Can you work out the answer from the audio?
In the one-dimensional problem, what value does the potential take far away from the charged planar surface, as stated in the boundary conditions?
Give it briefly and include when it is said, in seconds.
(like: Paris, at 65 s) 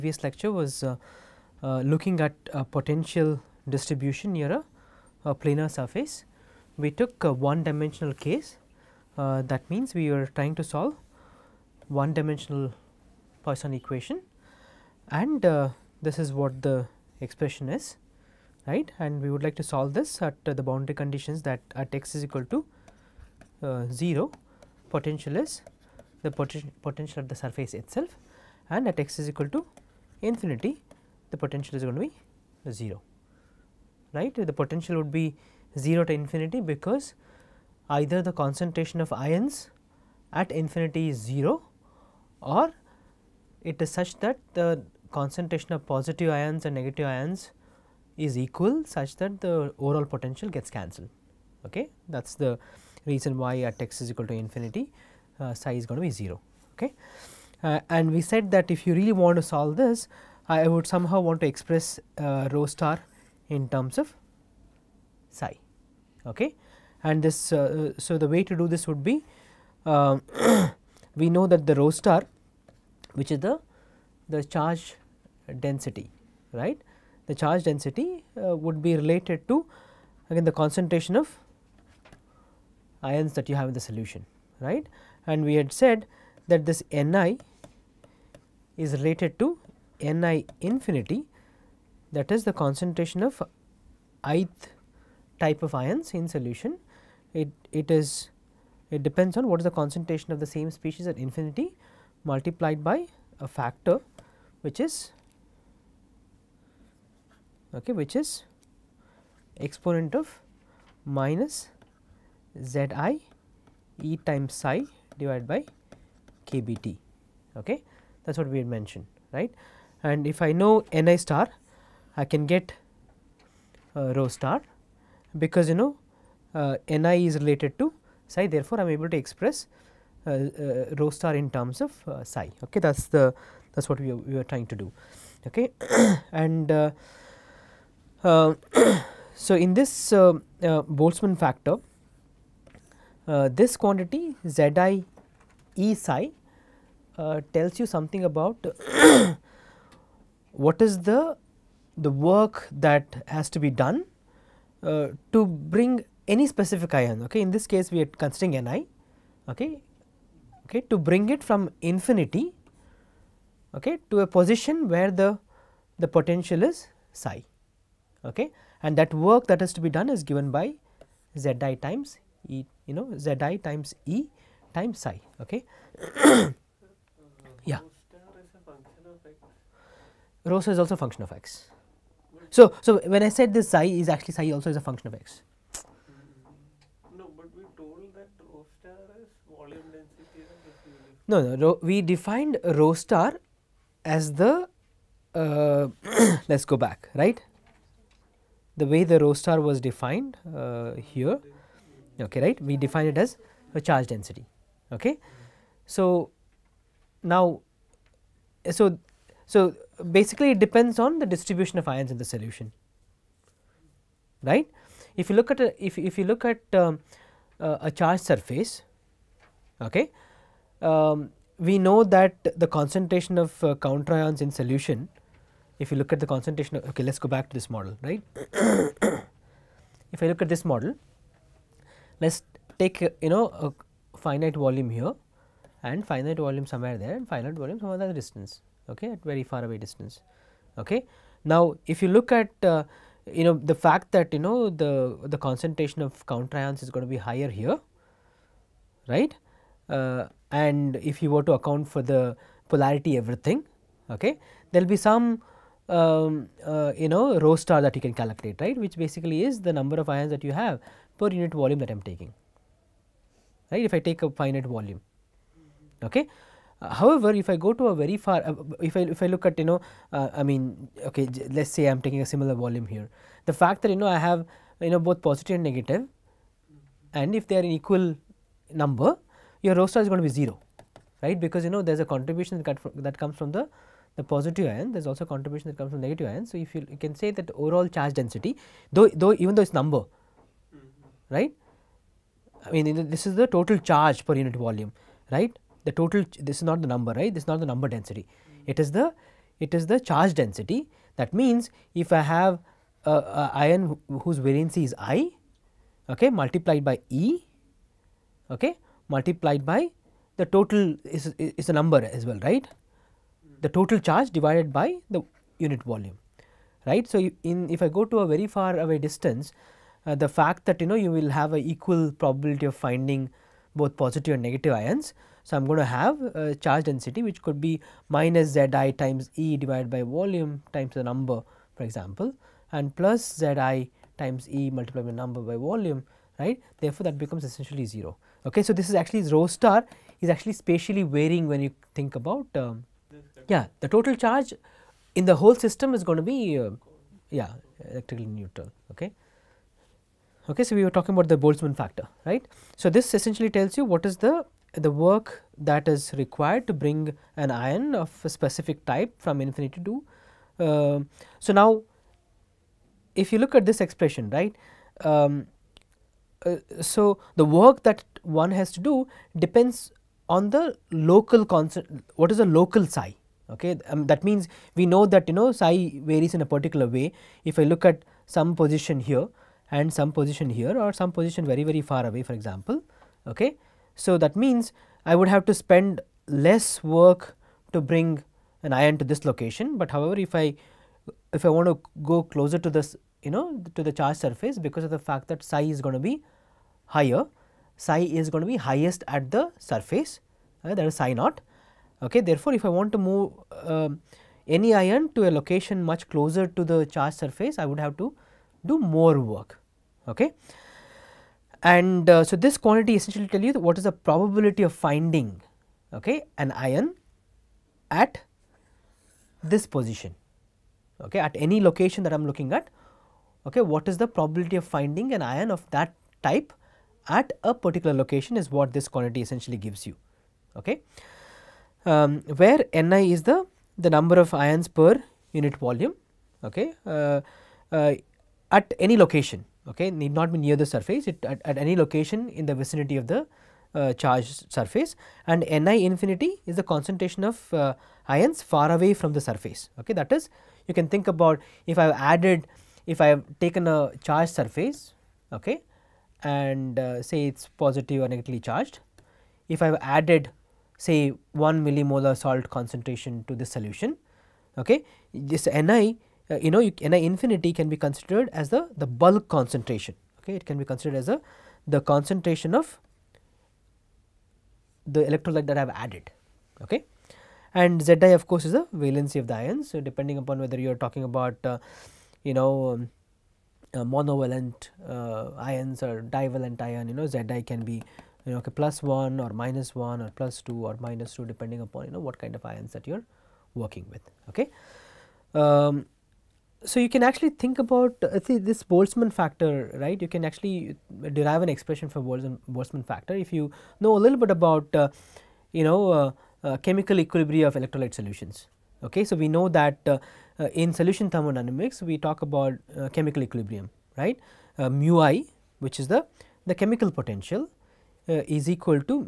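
0, at 31 s.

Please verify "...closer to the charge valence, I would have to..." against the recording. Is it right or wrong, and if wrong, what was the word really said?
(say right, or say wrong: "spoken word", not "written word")
wrong: "surface", not "valence".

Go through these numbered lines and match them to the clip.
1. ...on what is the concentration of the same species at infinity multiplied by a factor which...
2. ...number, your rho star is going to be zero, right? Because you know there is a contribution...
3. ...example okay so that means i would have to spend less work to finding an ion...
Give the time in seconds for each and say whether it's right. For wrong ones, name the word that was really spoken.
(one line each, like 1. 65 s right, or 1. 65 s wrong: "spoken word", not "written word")
1. 99 s right
2. 278 s right
3. 382 s wrong: "bring", not "finding".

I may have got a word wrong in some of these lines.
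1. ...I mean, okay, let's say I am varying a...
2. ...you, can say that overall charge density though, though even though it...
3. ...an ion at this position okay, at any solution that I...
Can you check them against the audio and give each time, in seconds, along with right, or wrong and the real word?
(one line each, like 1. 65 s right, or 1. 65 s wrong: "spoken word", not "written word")
1. 270 s wrong: "taking", not "varying"
2. 286 s right
3. 416 s wrong: "location", not "solution".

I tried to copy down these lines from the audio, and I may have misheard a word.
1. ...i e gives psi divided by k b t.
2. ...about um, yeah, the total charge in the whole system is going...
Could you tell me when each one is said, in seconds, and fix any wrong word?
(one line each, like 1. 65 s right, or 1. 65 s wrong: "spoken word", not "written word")
1. 113 s wrong: "times", not "gives"
2. 342 s right.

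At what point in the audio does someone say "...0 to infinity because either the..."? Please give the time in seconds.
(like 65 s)
35 s.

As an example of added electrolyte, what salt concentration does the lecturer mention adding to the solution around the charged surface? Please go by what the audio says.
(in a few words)
1 millimolar.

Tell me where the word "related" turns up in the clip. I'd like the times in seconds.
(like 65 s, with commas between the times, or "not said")
78 s, 88 s, 127 s.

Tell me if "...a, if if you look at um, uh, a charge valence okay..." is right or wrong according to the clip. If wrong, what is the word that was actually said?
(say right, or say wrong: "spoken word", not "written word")
wrong: "surface", not "valence".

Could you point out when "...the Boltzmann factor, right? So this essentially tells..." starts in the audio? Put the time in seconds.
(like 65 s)
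351 s.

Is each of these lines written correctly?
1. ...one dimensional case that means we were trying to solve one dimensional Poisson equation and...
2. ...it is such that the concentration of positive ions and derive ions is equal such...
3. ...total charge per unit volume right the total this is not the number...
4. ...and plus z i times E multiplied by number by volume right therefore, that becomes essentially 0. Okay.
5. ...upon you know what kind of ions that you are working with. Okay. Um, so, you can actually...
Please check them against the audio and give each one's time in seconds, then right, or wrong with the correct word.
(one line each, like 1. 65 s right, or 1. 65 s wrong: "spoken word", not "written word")
1. 7 s right
2. 43 s wrong: "negative", not "derive"
3. 293 s right
4. 332 s right
5. 491 s right.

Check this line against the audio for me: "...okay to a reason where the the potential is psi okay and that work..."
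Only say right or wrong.
wrong.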